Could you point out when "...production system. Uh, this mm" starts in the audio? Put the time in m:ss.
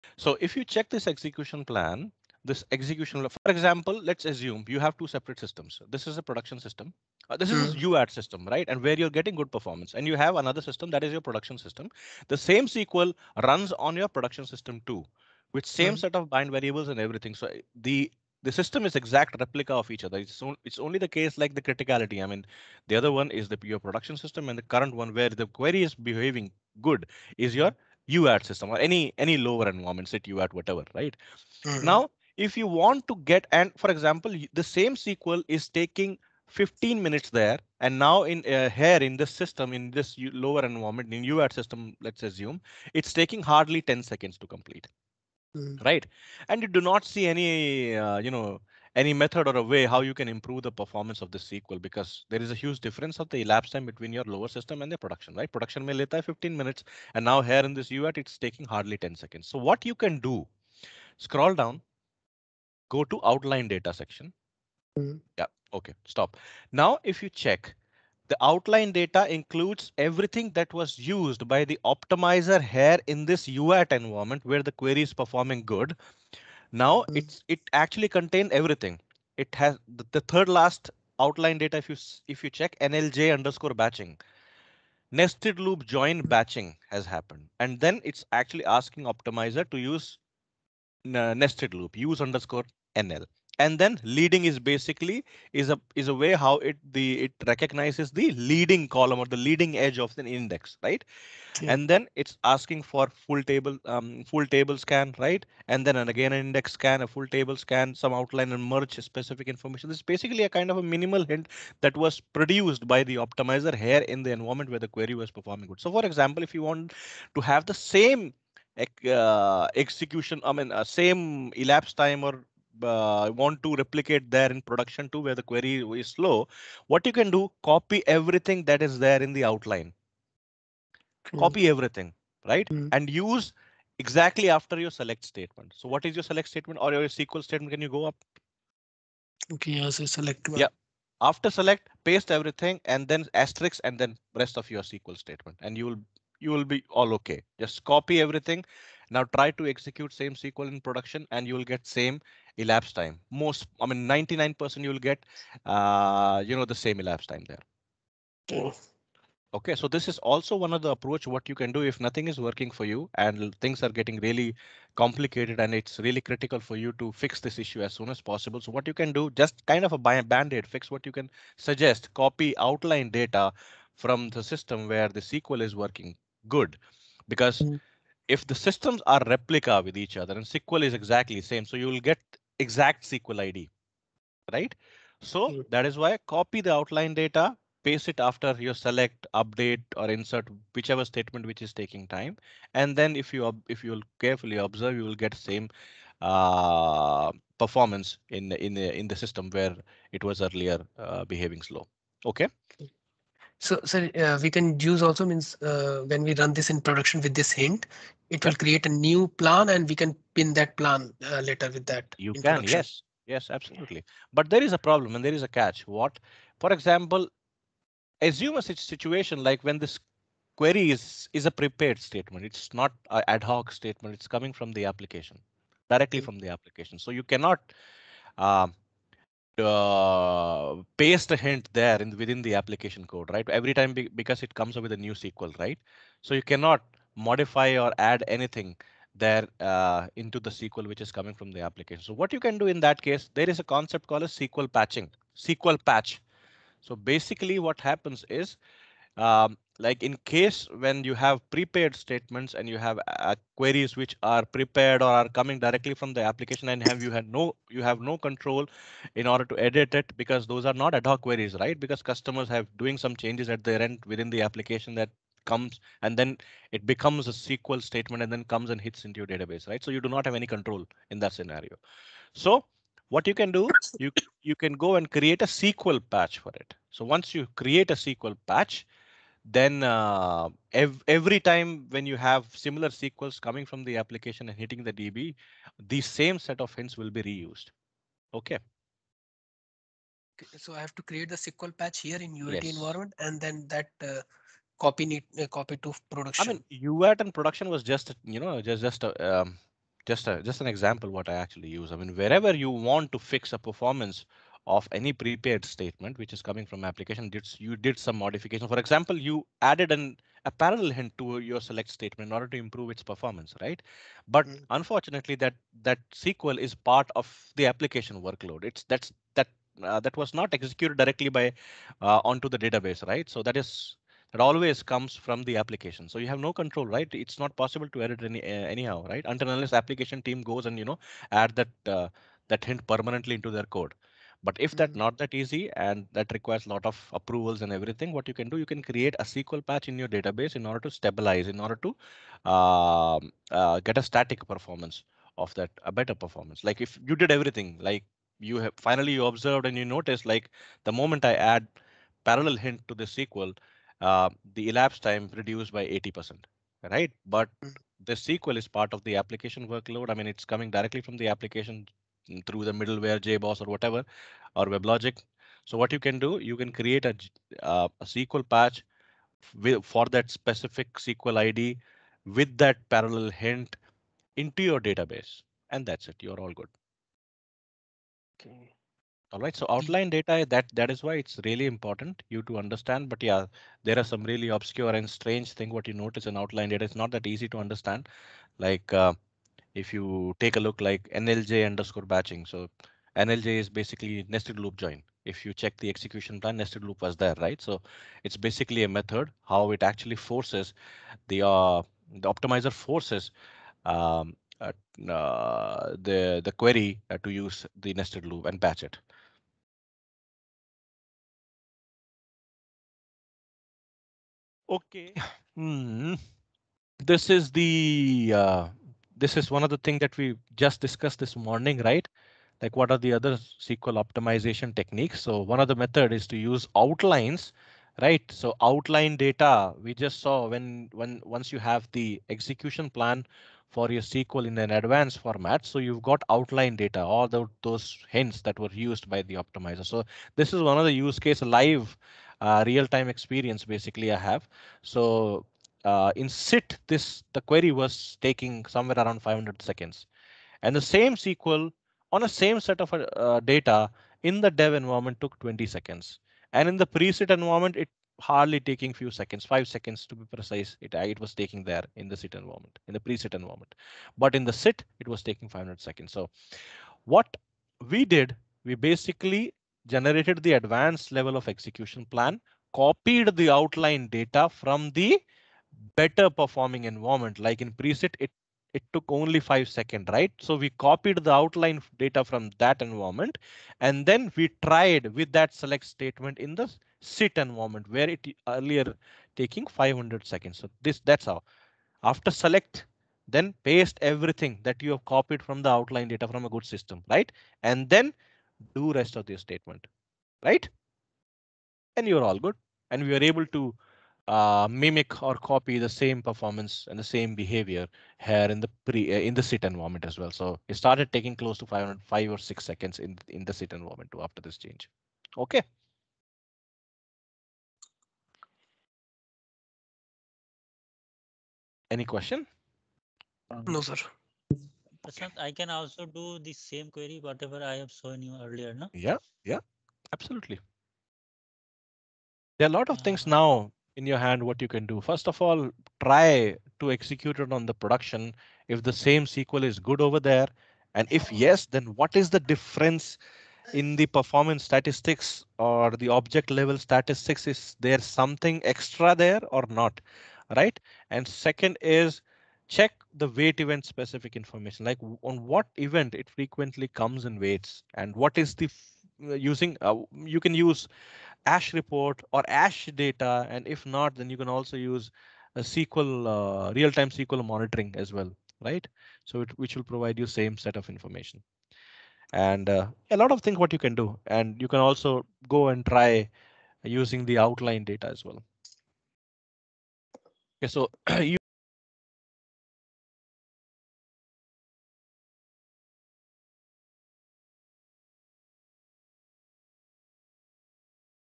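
0:06.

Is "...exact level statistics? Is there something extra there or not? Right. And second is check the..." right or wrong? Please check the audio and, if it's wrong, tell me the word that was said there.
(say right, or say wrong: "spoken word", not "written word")
wrong: "object", not "exact".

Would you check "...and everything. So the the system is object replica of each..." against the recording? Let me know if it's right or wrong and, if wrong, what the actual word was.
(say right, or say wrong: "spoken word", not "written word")
wrong: "exact", not "object".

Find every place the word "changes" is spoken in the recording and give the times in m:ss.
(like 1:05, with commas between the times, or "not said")
4:23, 8:34.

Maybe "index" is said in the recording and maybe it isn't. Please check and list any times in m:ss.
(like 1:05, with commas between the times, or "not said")
1:40, 1:46.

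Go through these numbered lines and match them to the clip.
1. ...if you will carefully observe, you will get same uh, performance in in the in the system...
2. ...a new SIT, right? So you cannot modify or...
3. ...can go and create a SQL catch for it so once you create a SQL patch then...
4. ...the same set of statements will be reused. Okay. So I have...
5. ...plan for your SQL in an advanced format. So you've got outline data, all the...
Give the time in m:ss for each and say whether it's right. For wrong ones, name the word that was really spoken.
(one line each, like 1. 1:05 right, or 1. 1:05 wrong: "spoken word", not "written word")
1. 3:13 right
2. 3:54 wrong: "SQL", not "SIT"
3. 4:34 wrong: "patch", not "catch"
4. 4:45 wrong: "hints", not "statements"
5. 7:12 right.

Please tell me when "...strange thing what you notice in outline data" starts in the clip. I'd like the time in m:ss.
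6:25.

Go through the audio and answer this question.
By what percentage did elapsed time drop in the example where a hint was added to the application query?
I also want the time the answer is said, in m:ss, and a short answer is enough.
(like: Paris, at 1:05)
80%, at 5:55.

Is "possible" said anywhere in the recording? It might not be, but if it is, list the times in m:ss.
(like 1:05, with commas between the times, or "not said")
2:48, 5:27.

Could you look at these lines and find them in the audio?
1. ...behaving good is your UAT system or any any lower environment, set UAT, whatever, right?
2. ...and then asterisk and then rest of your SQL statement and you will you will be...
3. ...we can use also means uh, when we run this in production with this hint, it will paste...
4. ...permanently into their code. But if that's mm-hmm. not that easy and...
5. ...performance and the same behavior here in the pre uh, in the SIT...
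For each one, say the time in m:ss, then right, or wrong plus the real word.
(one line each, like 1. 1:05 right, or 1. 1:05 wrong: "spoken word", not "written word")
1. 0:25 right
2. 2:22 right
3. 3:24 wrong: "create", not "paste"
4. 5:32 right
5. 8:26 right.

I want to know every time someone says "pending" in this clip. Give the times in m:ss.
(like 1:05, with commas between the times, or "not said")
not said.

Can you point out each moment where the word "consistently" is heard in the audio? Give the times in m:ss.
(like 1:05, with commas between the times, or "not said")
not said.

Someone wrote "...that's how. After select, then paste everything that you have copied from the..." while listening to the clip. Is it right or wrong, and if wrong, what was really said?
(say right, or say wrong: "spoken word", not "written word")
right.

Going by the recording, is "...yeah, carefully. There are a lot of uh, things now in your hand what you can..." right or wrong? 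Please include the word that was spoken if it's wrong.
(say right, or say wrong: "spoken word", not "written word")
wrong: "absolutely", not "carefully".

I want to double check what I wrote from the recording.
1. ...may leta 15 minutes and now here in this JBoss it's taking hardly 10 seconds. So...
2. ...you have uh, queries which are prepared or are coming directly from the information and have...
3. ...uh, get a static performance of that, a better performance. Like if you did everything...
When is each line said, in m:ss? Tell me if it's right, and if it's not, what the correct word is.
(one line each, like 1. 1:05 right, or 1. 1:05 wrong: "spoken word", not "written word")
1. 0:55 wrong: "UAT", not "JBoss"
2. 4:12 wrong: "application", not "information"
3. 5:43 right.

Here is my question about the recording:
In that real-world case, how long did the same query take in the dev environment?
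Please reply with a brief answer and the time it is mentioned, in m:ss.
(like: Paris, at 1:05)
20 seconds, at 7:35.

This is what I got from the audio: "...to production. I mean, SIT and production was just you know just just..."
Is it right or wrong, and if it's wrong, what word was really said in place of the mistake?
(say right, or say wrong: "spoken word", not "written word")
wrong: "UAT", not "SIT".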